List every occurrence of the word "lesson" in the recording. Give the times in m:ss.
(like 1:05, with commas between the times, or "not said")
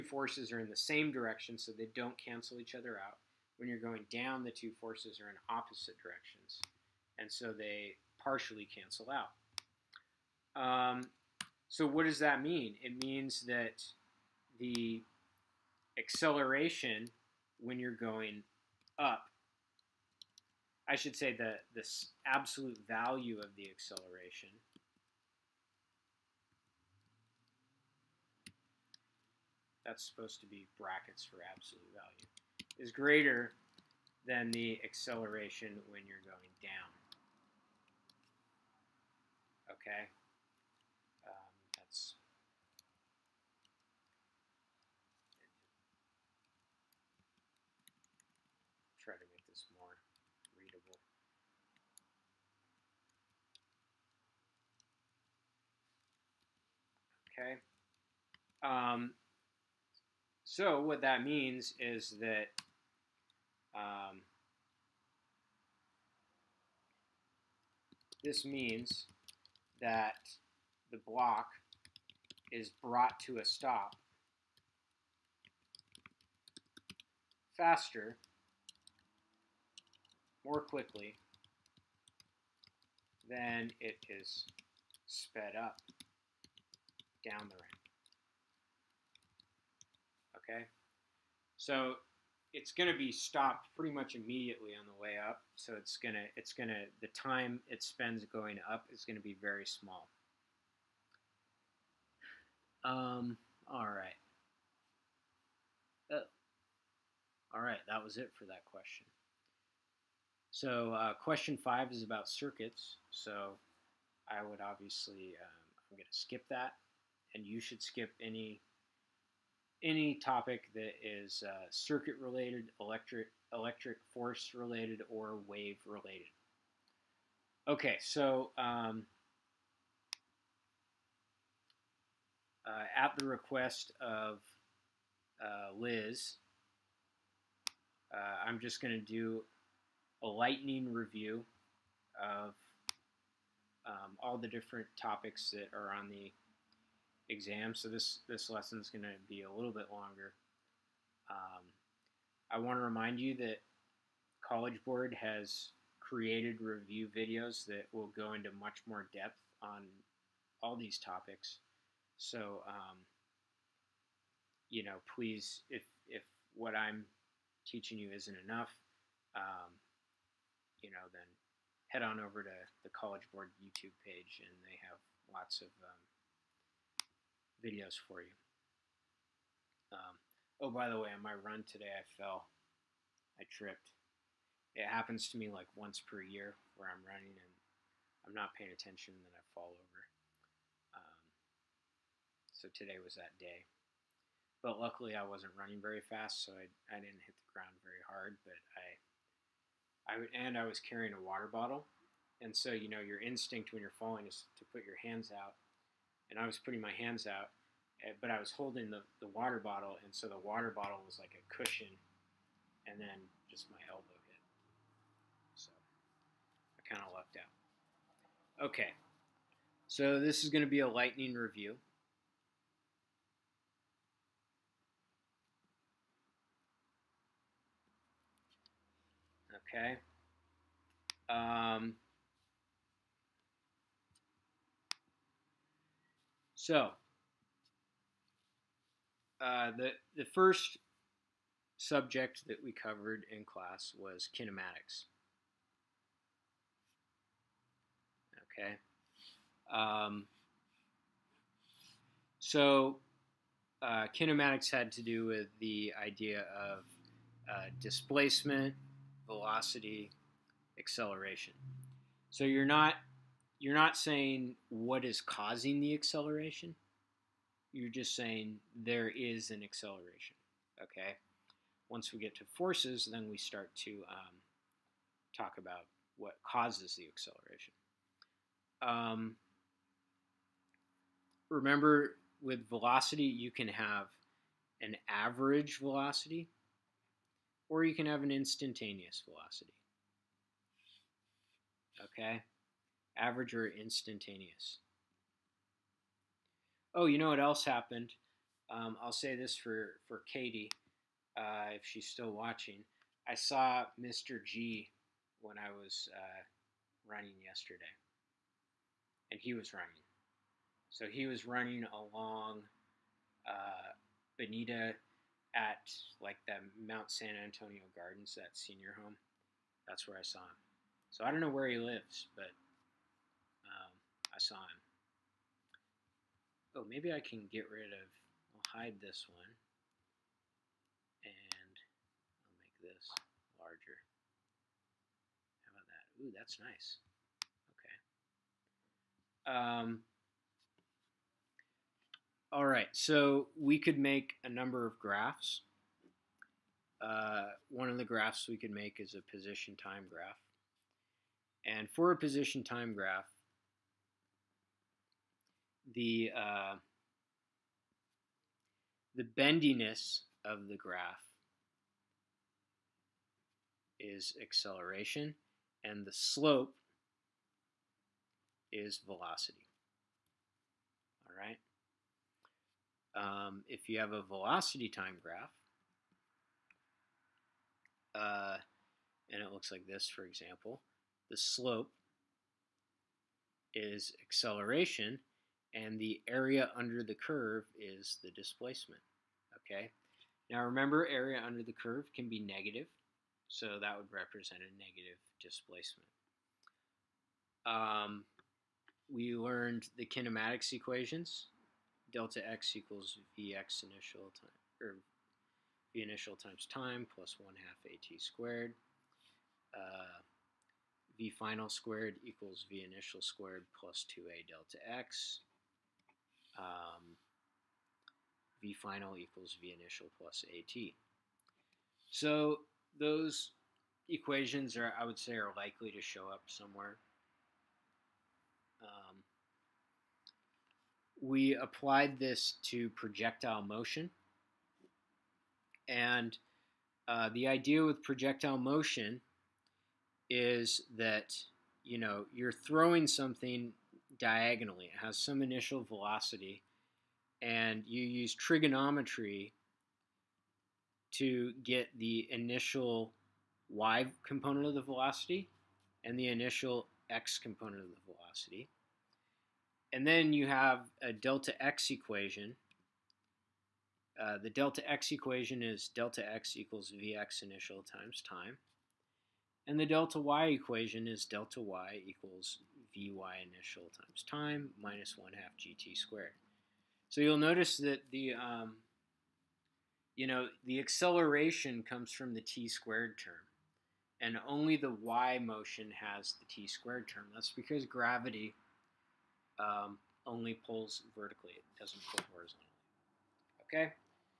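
2:28.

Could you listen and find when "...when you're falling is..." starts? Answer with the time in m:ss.
3:23.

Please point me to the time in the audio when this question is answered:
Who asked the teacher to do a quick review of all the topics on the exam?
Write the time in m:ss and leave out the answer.
2:15.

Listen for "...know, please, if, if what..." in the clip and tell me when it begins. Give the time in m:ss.
2:44.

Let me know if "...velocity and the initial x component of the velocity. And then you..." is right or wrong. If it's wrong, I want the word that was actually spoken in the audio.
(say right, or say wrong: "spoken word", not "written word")
right.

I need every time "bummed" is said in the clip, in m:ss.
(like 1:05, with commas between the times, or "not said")
not said.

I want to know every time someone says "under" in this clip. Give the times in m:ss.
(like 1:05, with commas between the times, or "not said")
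6:26, 6:31.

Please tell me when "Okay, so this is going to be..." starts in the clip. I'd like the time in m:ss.
3:38.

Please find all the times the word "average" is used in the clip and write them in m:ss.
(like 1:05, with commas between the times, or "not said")
4:45, 4:53.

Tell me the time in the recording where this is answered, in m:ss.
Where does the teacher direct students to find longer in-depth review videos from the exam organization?
2:52.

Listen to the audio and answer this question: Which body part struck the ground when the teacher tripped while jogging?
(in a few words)
elbow.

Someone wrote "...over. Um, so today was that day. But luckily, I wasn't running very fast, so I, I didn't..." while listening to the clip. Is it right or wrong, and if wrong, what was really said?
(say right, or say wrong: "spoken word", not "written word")
right.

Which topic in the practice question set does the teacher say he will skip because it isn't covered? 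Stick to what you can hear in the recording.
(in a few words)
circuits.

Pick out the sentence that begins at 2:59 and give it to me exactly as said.
Um, oh, by the way, on my run today, I fell.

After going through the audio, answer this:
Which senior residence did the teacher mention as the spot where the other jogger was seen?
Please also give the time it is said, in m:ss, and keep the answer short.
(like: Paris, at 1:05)
Mount San Antonio Gardens, at 5:16.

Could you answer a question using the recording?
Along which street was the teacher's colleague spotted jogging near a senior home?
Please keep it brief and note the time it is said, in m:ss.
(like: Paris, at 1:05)
Bonita, at 5:14.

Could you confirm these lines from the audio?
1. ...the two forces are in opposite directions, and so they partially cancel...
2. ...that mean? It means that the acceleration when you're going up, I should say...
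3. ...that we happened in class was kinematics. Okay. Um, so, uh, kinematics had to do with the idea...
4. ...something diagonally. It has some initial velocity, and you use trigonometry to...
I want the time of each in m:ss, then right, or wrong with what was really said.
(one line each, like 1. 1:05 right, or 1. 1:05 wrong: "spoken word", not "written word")
1. 0:04 right
2. 0:12 right
3. 4:02 wrong: "covered", not "happened"
4. 7:23 right.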